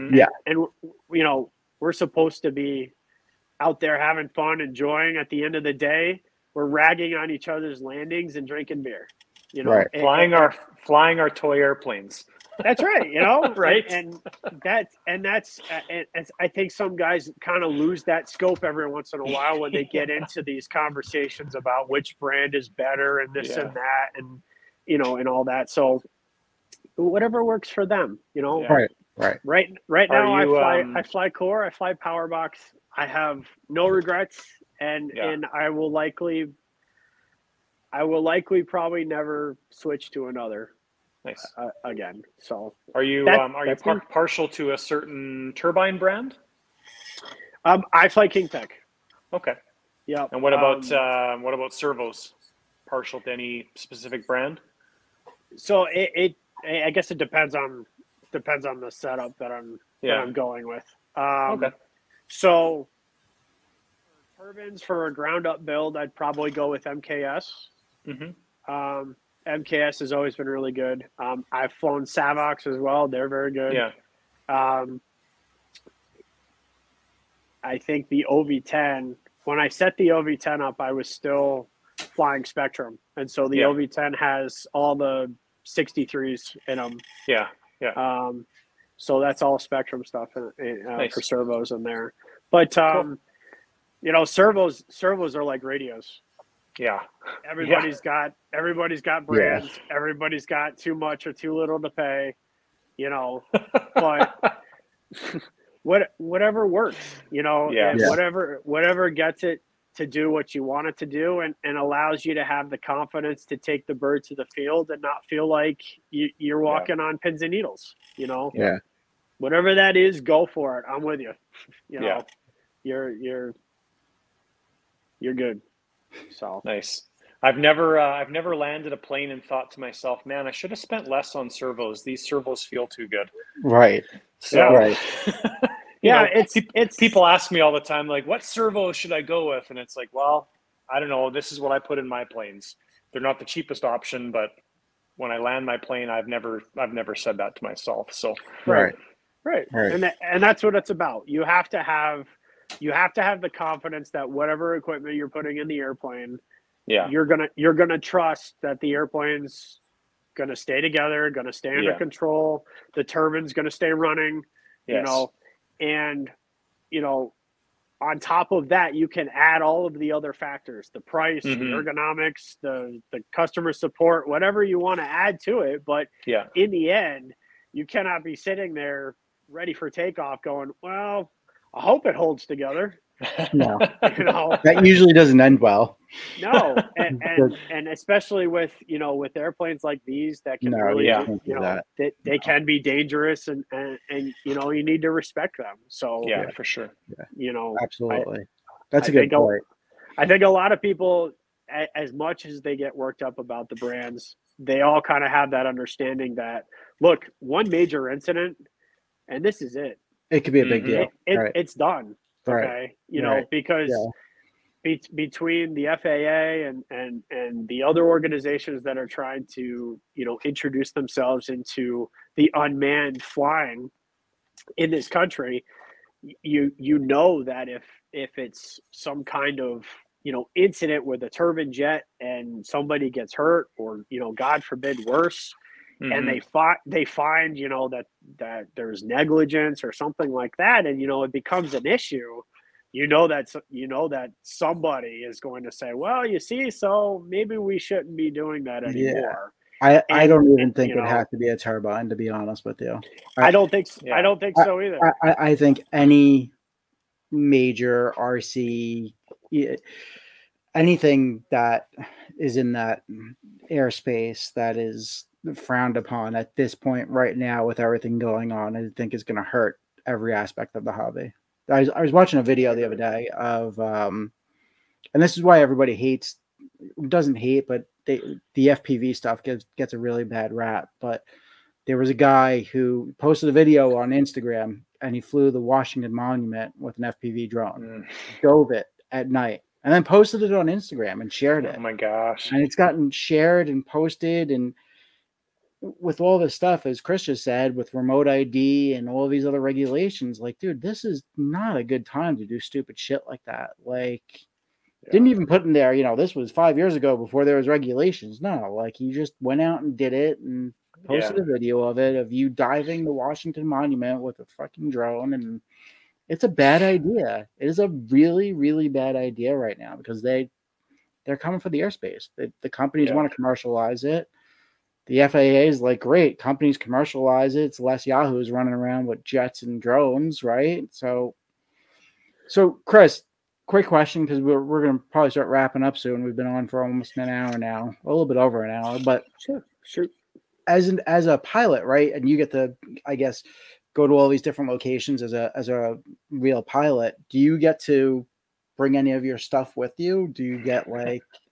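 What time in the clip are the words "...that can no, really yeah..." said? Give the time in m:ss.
3:10.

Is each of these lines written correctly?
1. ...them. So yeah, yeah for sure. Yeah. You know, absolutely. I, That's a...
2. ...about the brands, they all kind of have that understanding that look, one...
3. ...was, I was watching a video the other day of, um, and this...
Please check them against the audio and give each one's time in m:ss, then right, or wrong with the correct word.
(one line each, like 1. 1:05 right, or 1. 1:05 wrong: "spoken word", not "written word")
1. 3:15 right
2. 3:23 right
3. 4:31 right.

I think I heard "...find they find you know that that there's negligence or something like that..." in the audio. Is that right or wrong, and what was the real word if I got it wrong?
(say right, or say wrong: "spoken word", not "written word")
right.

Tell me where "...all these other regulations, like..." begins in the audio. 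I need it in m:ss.
4:59.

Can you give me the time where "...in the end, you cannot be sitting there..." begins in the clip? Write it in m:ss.
2:56.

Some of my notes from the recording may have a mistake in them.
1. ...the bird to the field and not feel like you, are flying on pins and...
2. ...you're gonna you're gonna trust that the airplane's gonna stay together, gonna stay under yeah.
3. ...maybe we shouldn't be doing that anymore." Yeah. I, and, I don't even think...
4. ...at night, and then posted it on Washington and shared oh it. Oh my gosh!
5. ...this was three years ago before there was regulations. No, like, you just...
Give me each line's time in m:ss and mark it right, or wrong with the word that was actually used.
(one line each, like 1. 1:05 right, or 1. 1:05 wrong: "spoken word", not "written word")
1. 1:53 wrong: "walking", not "flying"
2. 2:37 right
3. 4:07 right
4. 4:49 wrong: "Instagram", not "Washington"
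5. 5:06 wrong: "five", not "three".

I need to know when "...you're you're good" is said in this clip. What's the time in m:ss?
2:03.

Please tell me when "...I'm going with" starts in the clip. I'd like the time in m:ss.
1:00.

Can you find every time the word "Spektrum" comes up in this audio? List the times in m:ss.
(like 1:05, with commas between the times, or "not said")
1:22, 1:29.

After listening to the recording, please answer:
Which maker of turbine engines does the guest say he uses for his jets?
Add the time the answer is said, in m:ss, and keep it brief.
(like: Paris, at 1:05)
Kingtech, at 0:48.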